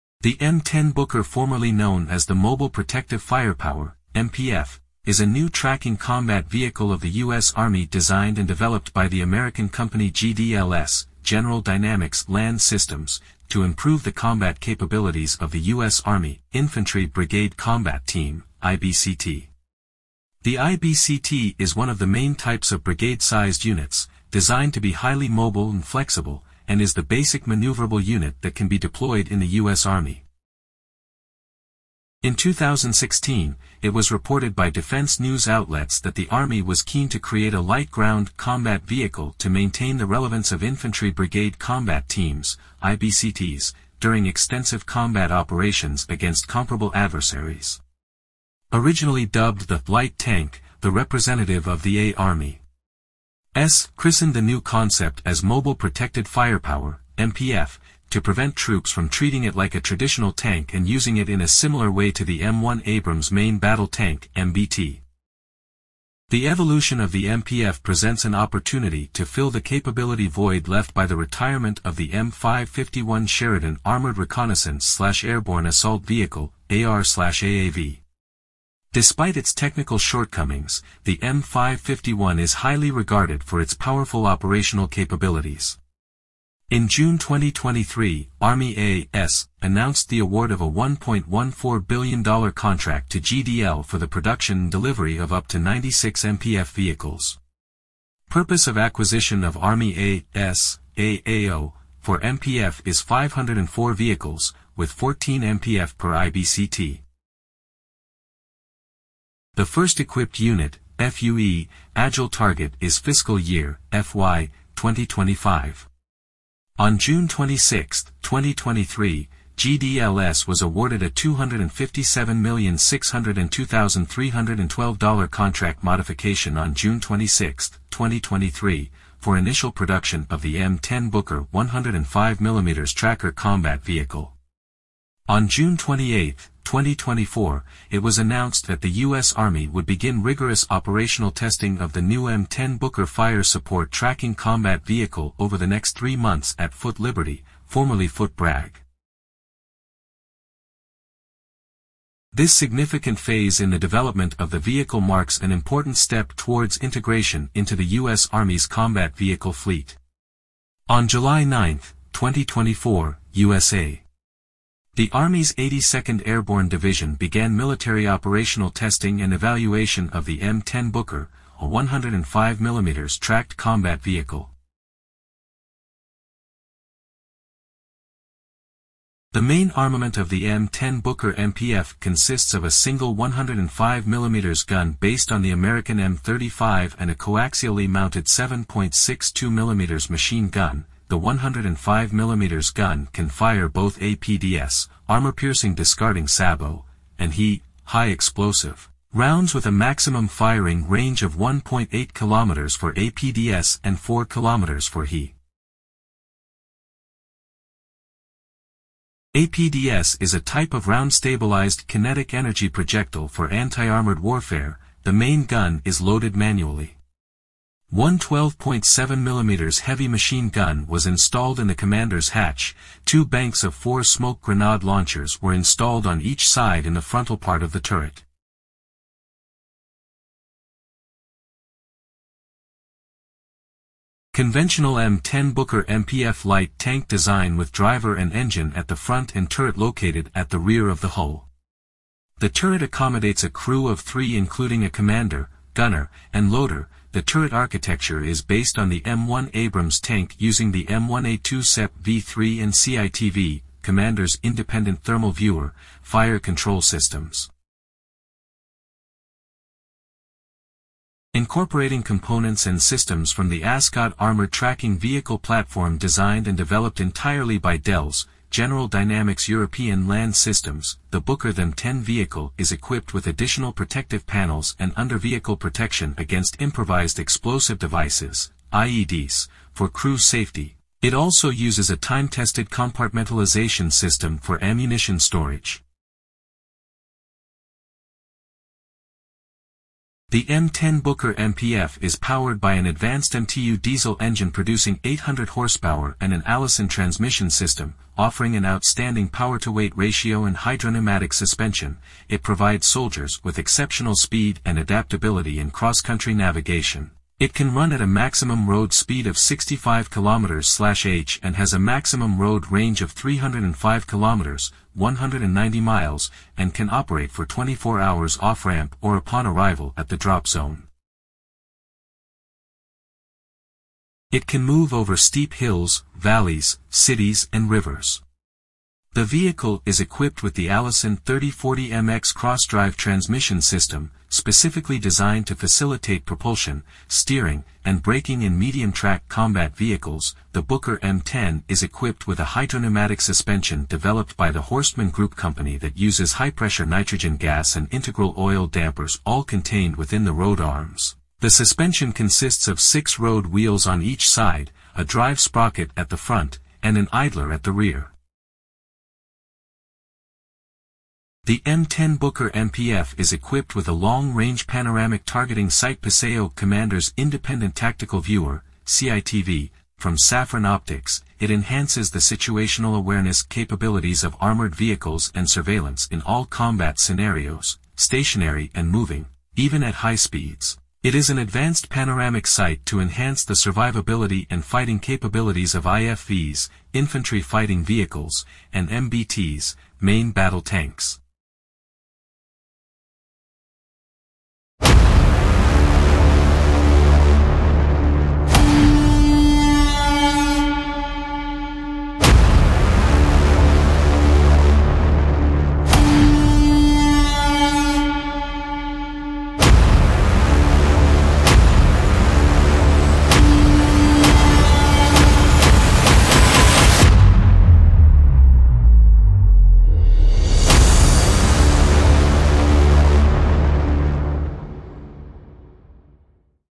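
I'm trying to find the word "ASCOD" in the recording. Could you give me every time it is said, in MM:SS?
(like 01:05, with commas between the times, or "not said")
04:23.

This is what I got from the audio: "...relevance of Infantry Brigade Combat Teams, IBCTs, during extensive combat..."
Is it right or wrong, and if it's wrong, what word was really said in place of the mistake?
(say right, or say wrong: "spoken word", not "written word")
right.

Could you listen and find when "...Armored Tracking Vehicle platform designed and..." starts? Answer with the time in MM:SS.
04:24.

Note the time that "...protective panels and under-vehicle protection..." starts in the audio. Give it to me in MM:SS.
04:33.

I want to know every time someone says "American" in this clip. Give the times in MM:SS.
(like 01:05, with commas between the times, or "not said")
00:09, 03:05.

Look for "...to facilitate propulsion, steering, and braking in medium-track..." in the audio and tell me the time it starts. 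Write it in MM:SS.
05:35.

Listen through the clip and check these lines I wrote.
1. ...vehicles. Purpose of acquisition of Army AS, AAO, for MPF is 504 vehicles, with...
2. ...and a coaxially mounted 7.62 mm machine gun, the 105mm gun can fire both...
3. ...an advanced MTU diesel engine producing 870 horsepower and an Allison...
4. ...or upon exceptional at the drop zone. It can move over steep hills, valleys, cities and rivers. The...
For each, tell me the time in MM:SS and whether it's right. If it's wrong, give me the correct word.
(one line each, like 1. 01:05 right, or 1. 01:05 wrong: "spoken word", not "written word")
1. 01:36 right
2. 03:06 right
3. 04:52 wrong: "800", not "870"
4. 05:19 wrong: "arrival", not "exceptional".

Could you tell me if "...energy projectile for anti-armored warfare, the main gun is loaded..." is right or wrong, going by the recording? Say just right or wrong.
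right.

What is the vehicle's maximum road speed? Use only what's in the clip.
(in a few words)
65 km/h.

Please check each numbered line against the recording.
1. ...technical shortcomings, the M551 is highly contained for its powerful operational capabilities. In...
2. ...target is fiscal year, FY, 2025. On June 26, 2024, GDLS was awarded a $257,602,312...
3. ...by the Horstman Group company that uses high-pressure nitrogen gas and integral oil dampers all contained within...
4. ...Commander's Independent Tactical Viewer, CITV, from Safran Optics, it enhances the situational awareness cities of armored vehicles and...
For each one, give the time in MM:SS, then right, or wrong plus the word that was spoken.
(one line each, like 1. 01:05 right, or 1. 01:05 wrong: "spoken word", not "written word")
1. 01:19 wrong: "regarded", not "contained"
2. 01:52 wrong: "2023", not "2024"
3. 05:44 right
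4. 06:06 wrong: "capabilities", not "cities".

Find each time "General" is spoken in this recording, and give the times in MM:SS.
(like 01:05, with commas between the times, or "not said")
00:11, 04:28.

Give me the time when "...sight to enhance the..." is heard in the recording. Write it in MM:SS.
06:22.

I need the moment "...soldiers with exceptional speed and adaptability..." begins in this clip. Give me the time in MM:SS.
05:02.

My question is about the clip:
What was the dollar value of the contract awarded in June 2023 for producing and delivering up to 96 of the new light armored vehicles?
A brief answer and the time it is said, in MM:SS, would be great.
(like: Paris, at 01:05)
$1.14 billion, at 01:30.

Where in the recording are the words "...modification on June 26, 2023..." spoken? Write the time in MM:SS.
02:05.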